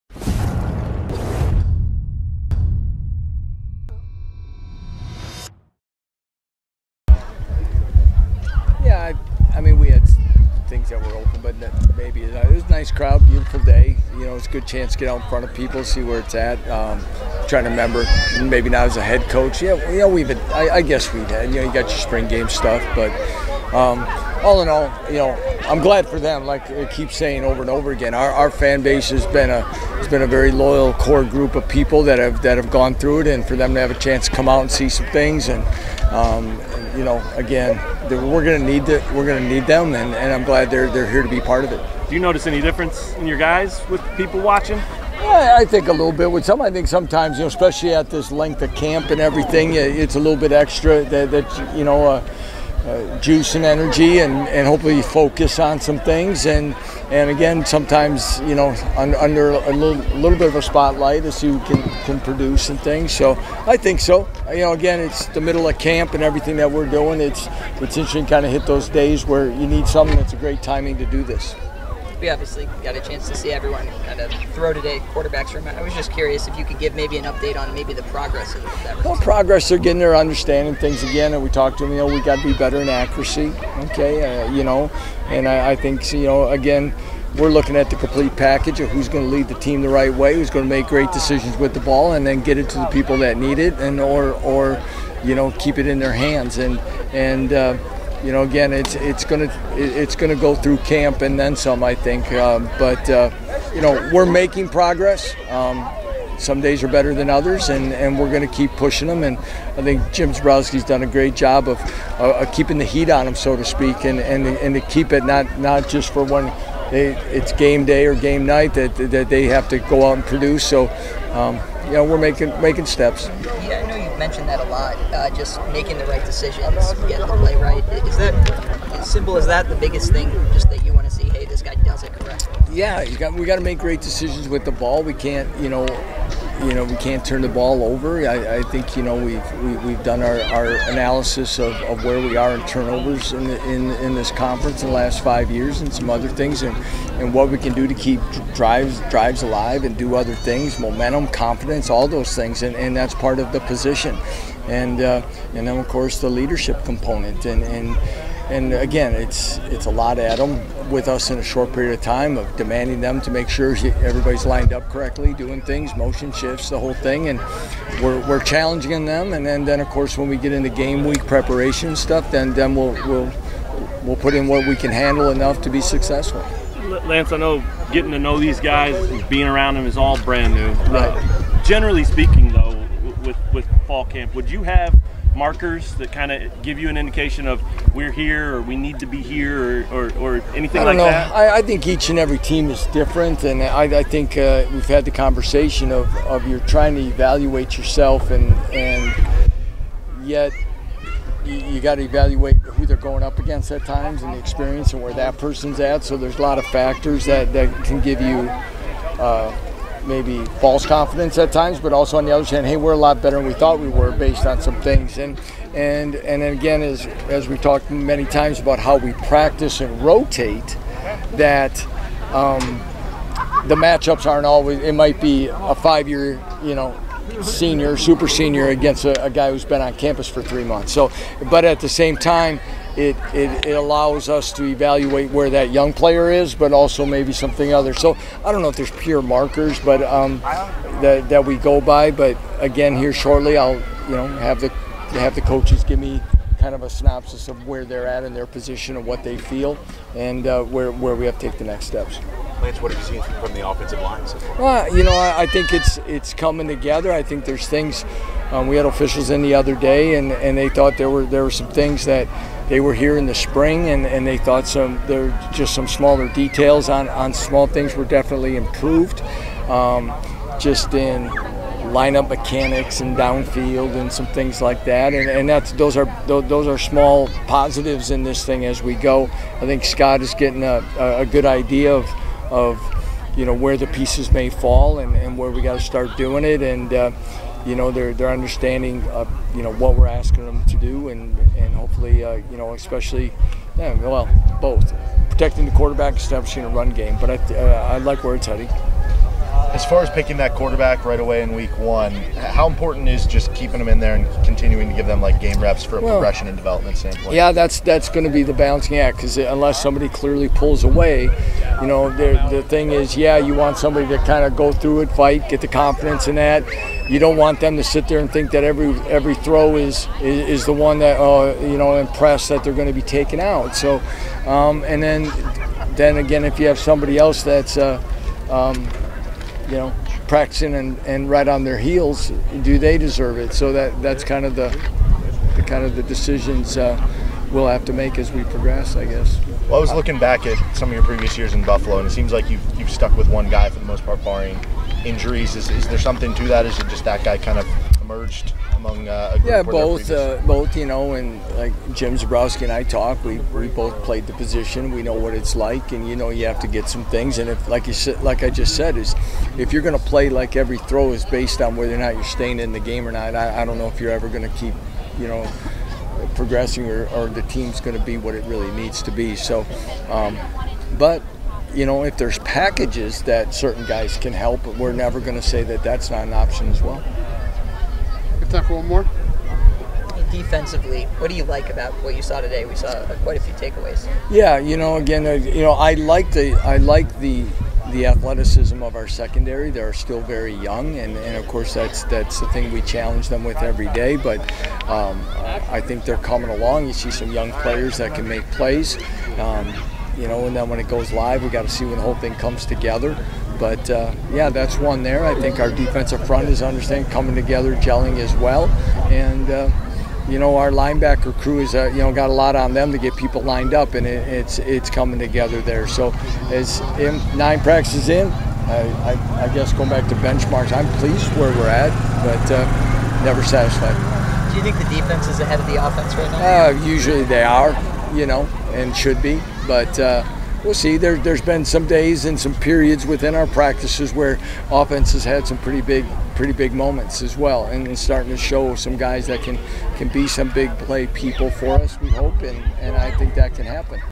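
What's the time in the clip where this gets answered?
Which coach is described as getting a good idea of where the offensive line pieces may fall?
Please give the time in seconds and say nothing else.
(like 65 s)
279 s.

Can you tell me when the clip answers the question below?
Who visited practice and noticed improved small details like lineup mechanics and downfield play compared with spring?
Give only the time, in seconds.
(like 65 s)
258 s.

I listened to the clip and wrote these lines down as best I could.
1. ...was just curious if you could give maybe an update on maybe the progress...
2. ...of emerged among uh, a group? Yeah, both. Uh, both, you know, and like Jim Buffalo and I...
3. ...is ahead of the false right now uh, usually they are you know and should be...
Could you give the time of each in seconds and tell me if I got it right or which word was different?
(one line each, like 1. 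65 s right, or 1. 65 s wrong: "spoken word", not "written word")
1. 75 s right
2. 347 s wrong: "Zebrowski", not "Buffalo"
3. 425 s wrong: "offense", not "false".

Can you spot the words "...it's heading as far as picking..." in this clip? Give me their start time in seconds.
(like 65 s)
298 s.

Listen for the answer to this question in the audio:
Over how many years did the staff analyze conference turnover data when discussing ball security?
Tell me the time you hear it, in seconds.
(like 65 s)
145 s.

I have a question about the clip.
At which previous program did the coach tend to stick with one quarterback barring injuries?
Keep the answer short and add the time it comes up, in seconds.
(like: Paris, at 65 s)
Buffalo, at 341 s.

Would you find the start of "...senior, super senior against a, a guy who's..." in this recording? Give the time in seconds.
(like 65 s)
227 s.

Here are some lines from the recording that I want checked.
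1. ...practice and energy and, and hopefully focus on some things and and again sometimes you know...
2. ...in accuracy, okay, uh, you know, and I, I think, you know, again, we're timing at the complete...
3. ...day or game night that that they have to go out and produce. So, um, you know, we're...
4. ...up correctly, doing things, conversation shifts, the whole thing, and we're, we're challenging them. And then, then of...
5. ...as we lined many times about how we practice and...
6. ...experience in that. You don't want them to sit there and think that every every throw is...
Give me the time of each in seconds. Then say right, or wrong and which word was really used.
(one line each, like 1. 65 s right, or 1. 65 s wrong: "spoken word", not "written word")
1. 53 s wrong: "juice", not "practice"
2. 82 s wrong: "looking", not "timing"
3. 117 s right
4. 164 s wrong: "motion", not "conversation"
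5. 217 s wrong: "talked", not "lined"
6. 315 s wrong: "confidence", not "experience".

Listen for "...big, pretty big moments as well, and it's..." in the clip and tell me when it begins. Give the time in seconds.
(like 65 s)
435 s.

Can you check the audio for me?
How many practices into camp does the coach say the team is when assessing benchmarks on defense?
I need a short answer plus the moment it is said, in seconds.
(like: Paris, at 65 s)
9, at 417 s.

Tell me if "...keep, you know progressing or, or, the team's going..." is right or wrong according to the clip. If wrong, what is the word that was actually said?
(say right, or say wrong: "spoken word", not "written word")
right.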